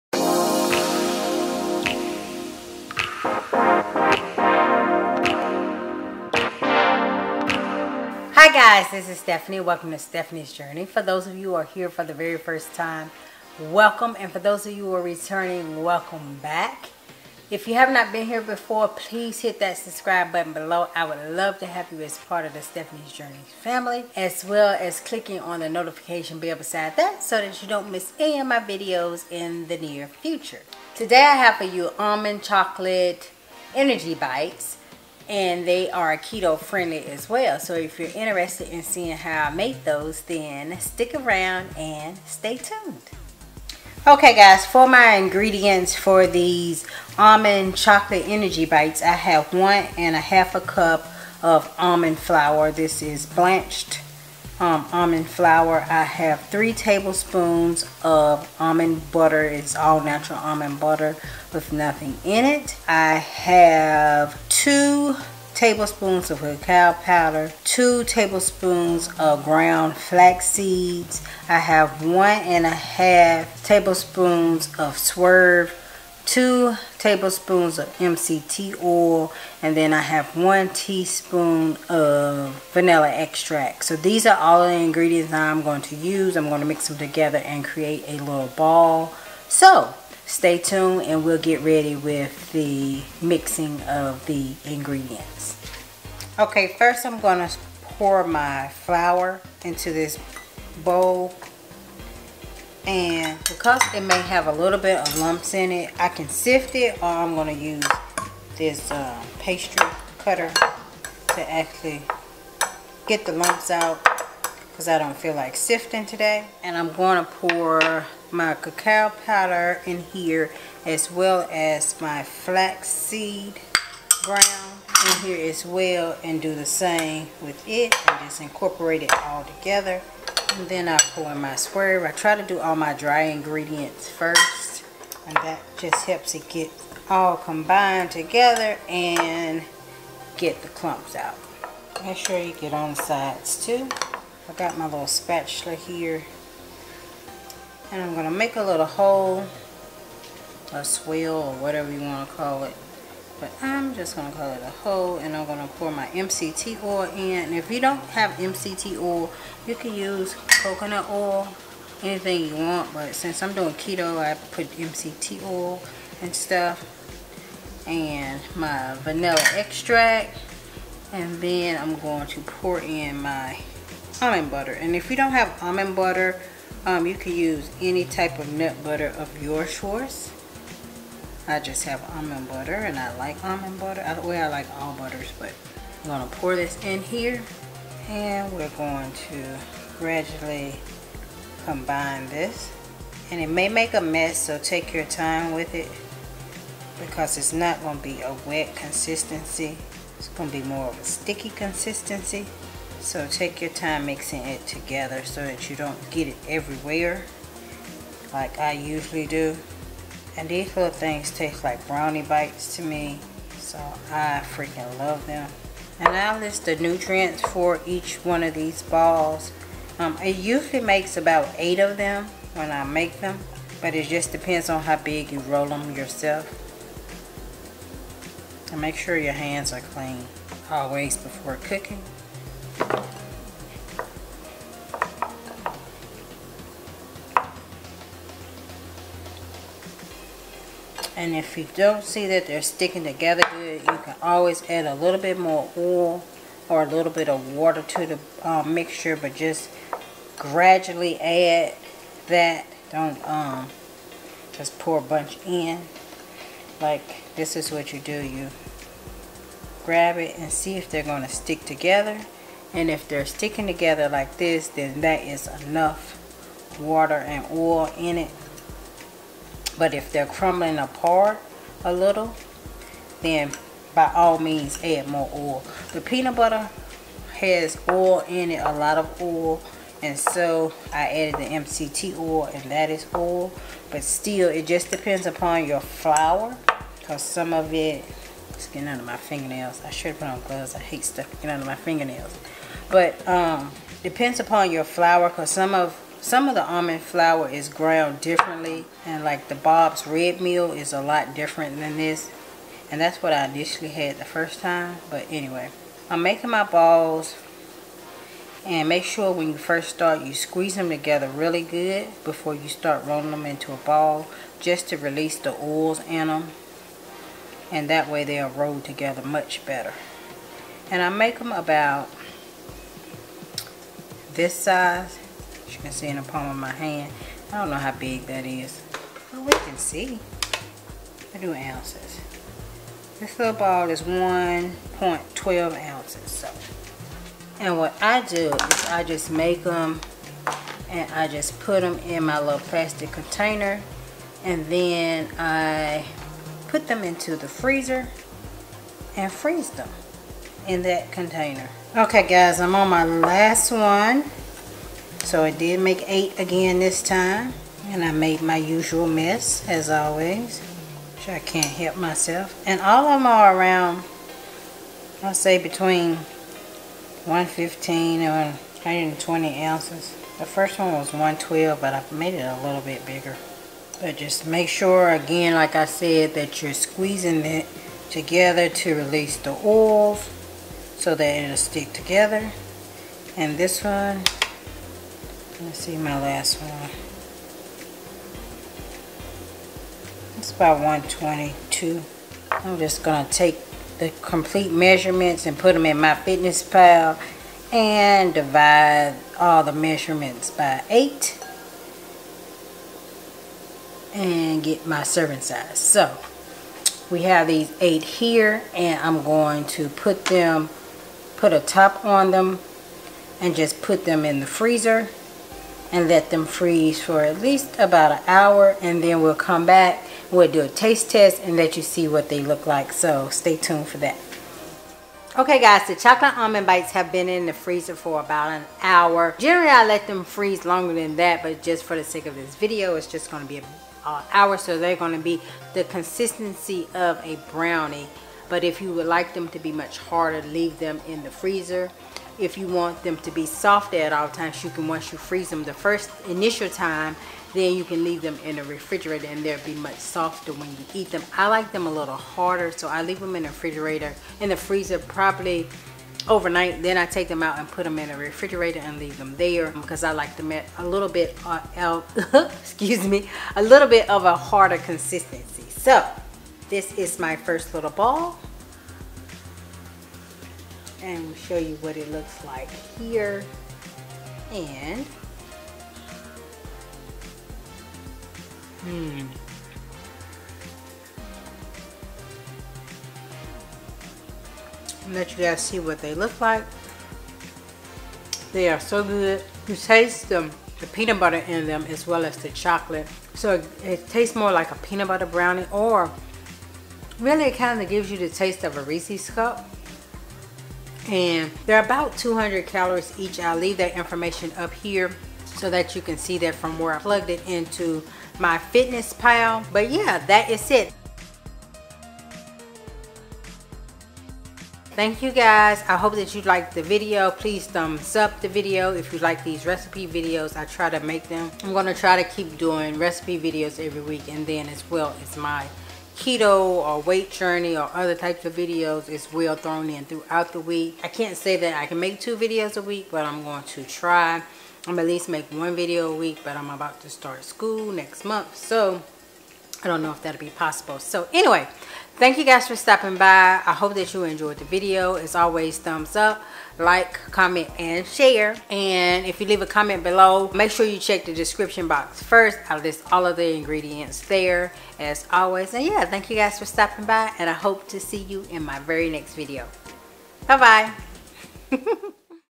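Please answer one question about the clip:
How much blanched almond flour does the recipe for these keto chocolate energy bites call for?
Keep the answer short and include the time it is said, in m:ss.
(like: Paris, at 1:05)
1.5 cups, at 0:49.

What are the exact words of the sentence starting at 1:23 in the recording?
So these are all the ingredients I'm going to use.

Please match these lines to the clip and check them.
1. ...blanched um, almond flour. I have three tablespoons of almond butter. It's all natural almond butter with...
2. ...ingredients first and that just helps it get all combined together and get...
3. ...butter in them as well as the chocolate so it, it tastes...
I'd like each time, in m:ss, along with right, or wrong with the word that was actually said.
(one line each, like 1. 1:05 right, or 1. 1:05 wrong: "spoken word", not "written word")
1. 0:53 right
2. 2:13 right
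3. 8:11 right.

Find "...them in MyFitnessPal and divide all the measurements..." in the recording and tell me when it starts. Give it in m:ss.
6:35.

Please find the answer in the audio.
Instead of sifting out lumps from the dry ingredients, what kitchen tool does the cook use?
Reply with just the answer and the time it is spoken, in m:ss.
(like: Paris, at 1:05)
pastry cutter, at 1:49.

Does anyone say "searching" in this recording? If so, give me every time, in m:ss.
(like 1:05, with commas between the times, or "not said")
not said.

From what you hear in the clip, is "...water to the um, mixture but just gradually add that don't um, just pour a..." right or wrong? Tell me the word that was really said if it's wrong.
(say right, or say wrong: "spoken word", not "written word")
right.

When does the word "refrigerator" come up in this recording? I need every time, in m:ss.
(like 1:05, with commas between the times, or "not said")
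7:28, 7:33, 7:38.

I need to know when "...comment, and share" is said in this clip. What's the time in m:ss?
9:07.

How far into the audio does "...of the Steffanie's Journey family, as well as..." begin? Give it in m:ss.
0:22.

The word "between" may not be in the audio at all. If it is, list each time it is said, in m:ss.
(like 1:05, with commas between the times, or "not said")
6:05.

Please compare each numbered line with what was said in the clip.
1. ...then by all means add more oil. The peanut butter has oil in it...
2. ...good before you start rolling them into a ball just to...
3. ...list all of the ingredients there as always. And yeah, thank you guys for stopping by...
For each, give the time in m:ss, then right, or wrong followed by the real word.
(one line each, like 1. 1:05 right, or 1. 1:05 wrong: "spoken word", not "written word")
1. 4:33 right
2. 5:11 right
3. 9:12 right.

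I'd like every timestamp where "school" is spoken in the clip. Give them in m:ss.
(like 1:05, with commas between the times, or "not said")
8:57.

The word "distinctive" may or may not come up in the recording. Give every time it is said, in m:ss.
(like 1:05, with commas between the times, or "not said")
not said.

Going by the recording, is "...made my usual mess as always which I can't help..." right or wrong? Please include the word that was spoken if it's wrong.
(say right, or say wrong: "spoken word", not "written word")
right.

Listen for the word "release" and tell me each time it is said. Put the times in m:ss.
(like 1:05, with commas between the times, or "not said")
5:14, 6:18.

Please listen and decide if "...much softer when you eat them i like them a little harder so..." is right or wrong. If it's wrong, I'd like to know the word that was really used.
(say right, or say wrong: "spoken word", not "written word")
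right.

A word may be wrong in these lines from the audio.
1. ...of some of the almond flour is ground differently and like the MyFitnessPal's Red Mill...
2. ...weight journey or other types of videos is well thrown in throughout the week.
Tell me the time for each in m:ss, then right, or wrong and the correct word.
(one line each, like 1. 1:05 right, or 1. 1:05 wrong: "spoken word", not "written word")
1. 4:55 wrong: "Bob", not "MyFitnessPal"
2. 8:47 right.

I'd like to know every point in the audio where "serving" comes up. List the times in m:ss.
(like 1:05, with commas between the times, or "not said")
6:45.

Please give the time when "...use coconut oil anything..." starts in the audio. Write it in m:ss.
2:39.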